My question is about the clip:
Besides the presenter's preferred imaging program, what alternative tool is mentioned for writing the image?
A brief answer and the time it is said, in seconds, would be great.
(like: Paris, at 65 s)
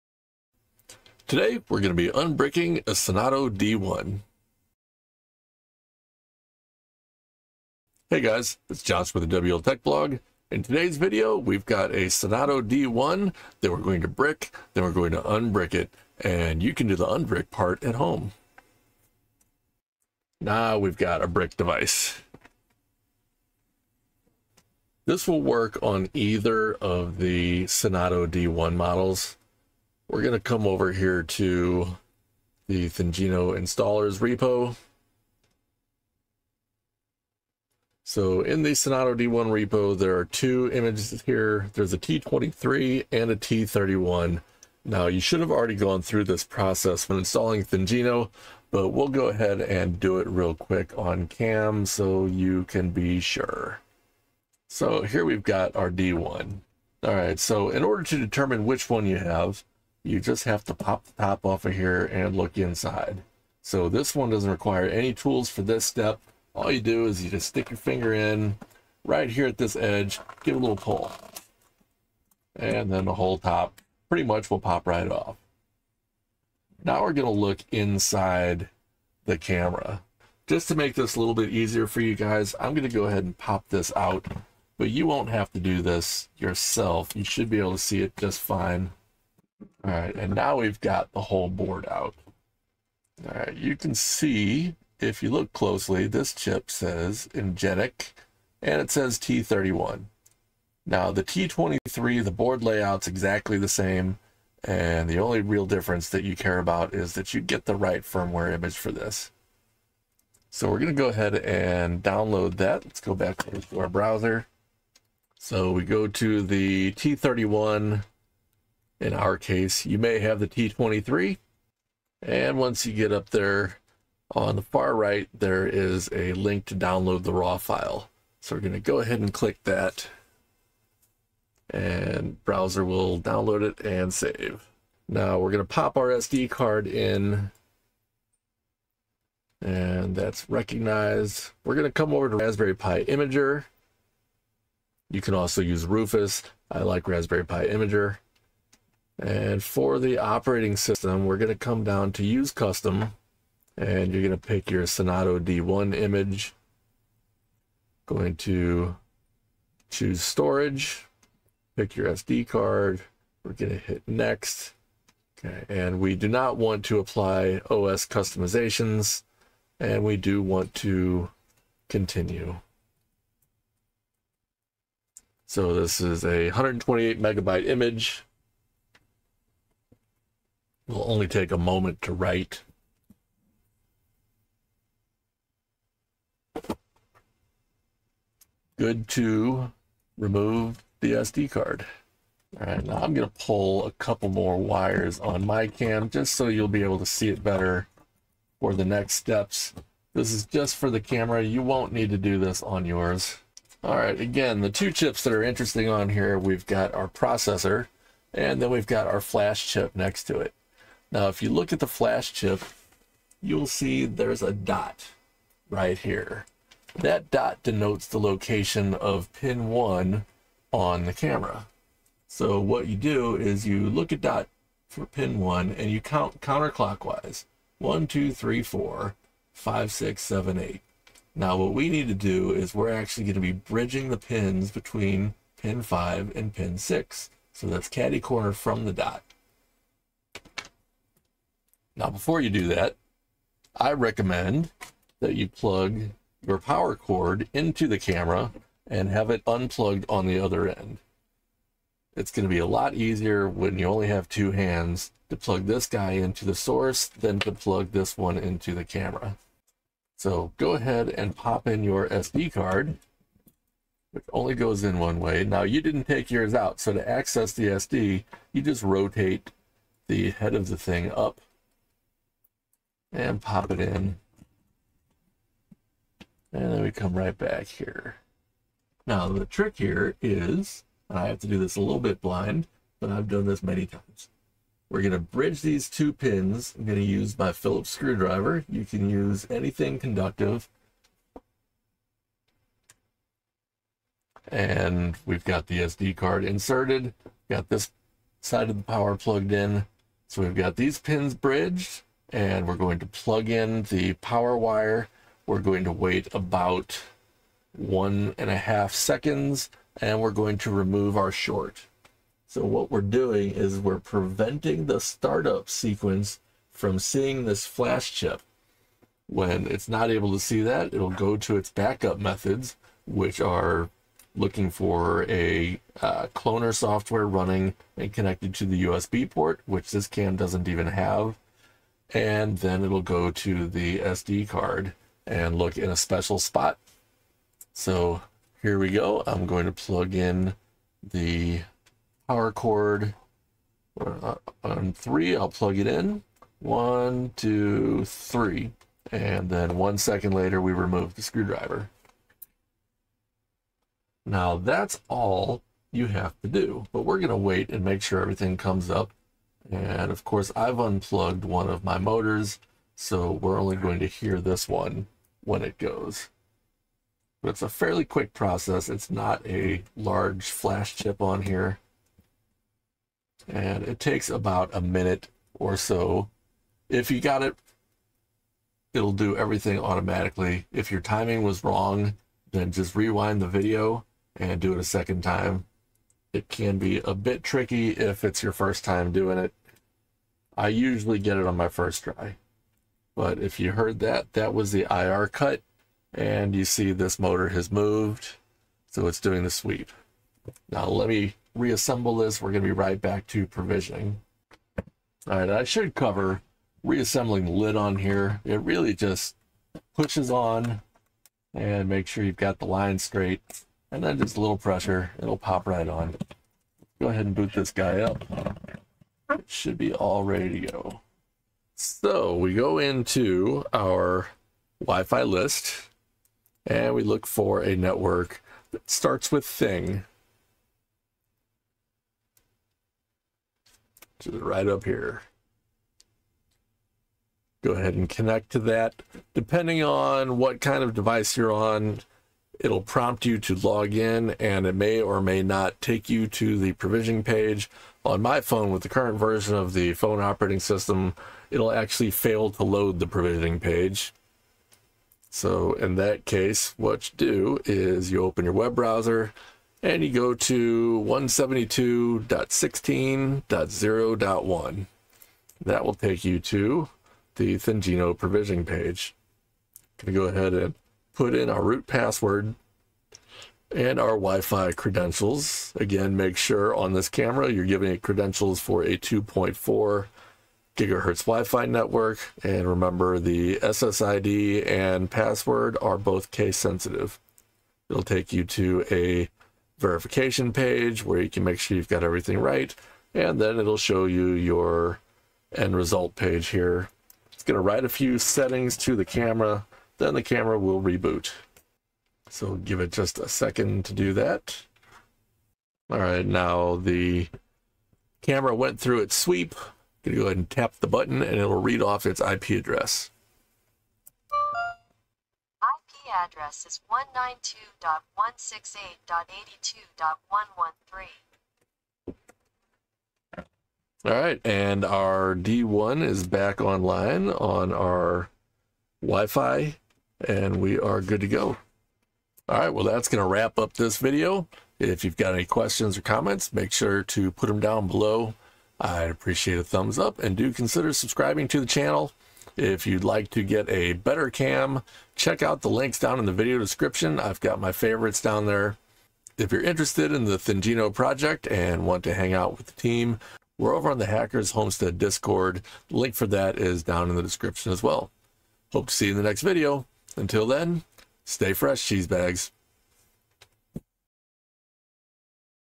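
Rufus, at 145 s.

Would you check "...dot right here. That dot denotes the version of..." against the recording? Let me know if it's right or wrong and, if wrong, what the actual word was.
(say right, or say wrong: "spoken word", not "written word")
wrong: "location", not "version".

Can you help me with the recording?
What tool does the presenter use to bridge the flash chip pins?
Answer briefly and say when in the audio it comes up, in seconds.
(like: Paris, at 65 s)
Phillips screwdriver, at 287 s.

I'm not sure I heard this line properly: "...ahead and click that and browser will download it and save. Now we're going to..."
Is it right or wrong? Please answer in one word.
right.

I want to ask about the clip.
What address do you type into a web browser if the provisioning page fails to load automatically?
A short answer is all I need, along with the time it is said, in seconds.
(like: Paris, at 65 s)
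172.16.0.1, at 461 s.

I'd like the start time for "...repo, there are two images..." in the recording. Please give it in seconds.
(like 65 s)
39 s.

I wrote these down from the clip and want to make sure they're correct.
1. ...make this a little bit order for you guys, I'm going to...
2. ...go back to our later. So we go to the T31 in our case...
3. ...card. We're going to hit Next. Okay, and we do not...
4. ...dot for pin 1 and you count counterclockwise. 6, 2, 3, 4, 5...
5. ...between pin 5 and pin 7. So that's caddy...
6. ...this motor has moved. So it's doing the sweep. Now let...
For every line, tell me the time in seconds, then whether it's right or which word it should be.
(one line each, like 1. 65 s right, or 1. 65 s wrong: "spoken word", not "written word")
1. 80 s wrong: "easier", not "order"
2. 113 s wrong: "browser", not "later"
3. 162 s right
4. 224 s wrong: "1", not "6"
5. 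234 s wrong: "6", not "7"
6. 396 s right.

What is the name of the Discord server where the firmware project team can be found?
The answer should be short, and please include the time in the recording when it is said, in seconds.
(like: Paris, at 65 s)
Hackers Homestead, at 554 s.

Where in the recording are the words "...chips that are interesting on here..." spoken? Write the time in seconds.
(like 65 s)
204 s.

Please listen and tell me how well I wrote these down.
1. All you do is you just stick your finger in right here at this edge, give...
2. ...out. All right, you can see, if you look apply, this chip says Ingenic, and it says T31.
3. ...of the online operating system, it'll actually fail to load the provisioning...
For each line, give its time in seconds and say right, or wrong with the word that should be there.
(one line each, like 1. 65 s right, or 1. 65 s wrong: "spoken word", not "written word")
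1. 66 s right
2. 91 s wrong: "closely", not "apply"
3. 449 s wrong: "phone", not "online".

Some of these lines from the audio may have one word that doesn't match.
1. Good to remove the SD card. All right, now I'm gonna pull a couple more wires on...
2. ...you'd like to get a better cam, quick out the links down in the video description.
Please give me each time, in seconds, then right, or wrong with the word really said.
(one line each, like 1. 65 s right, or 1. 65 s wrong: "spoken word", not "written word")
1. 188 s right
2. 542 s wrong: "check", not "quick".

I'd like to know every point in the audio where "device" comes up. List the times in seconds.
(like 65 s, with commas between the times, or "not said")
21 s, 440 s.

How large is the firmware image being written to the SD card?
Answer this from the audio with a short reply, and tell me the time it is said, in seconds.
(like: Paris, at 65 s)
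128 megabytes, at 176 s.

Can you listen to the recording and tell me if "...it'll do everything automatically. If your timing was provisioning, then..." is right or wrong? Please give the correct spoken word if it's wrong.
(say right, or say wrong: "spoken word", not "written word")
wrong: "wrong", not "provisioning".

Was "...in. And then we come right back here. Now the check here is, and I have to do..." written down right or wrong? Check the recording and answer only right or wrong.
wrong.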